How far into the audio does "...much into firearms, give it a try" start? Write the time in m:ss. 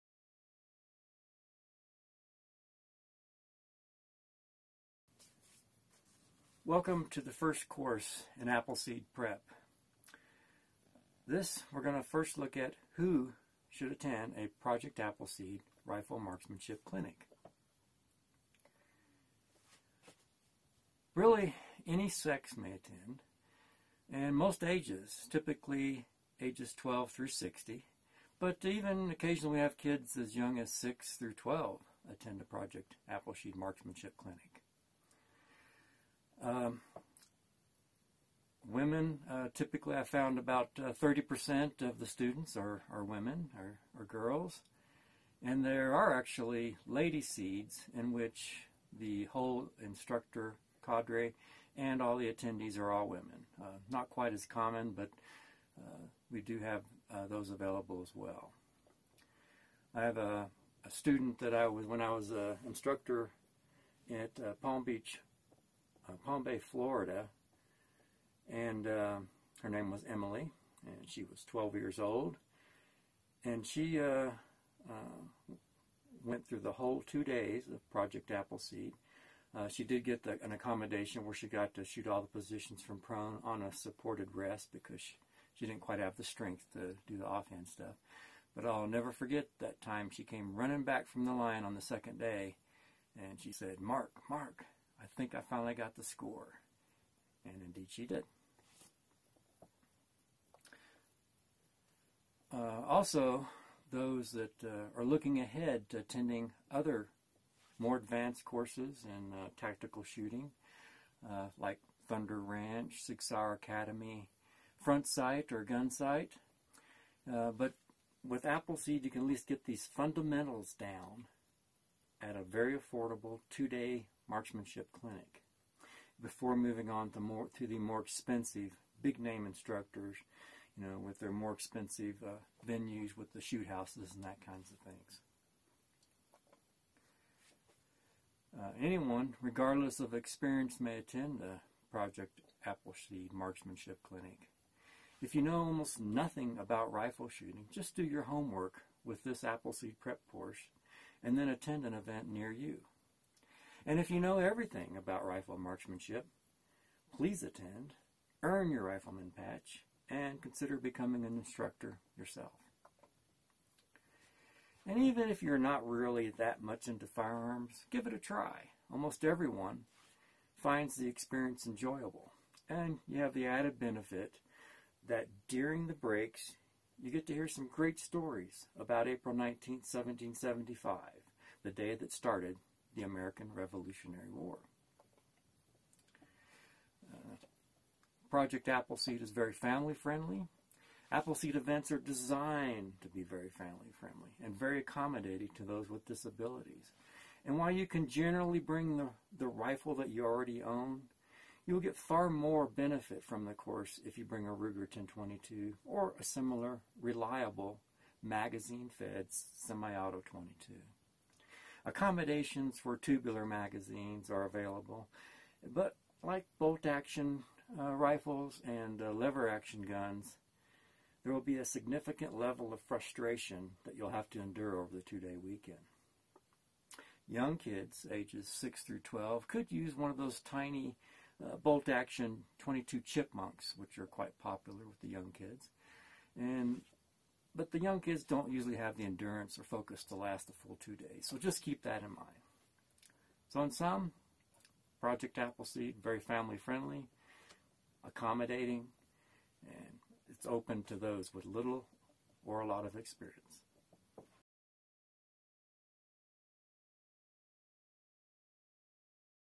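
2:46.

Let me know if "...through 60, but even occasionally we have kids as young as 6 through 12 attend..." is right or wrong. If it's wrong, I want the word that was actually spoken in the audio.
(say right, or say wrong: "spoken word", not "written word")
right.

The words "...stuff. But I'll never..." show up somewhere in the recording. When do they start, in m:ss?
1:27.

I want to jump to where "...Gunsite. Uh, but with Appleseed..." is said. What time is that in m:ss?
1:55.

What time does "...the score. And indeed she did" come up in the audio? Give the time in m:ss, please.
1:35.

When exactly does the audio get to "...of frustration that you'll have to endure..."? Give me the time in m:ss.
3:42.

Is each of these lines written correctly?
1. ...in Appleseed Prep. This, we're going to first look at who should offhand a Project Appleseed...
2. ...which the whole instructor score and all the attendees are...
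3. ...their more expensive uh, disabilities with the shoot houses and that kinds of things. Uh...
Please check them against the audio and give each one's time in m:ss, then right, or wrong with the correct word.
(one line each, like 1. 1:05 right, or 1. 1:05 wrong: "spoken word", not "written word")
1. 0:08 wrong: "attend", not "offhand"
2. 0:48 wrong: "cadre", not "score"
3. 2:11 wrong: "venues", not "disabilities".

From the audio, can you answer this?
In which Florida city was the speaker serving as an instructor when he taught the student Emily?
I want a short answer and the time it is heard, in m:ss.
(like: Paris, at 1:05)
Palm Bay, at 1:06.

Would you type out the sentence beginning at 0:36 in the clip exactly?
Um, women uh, typically I found about uh, 30% of the students are, are women or, girls.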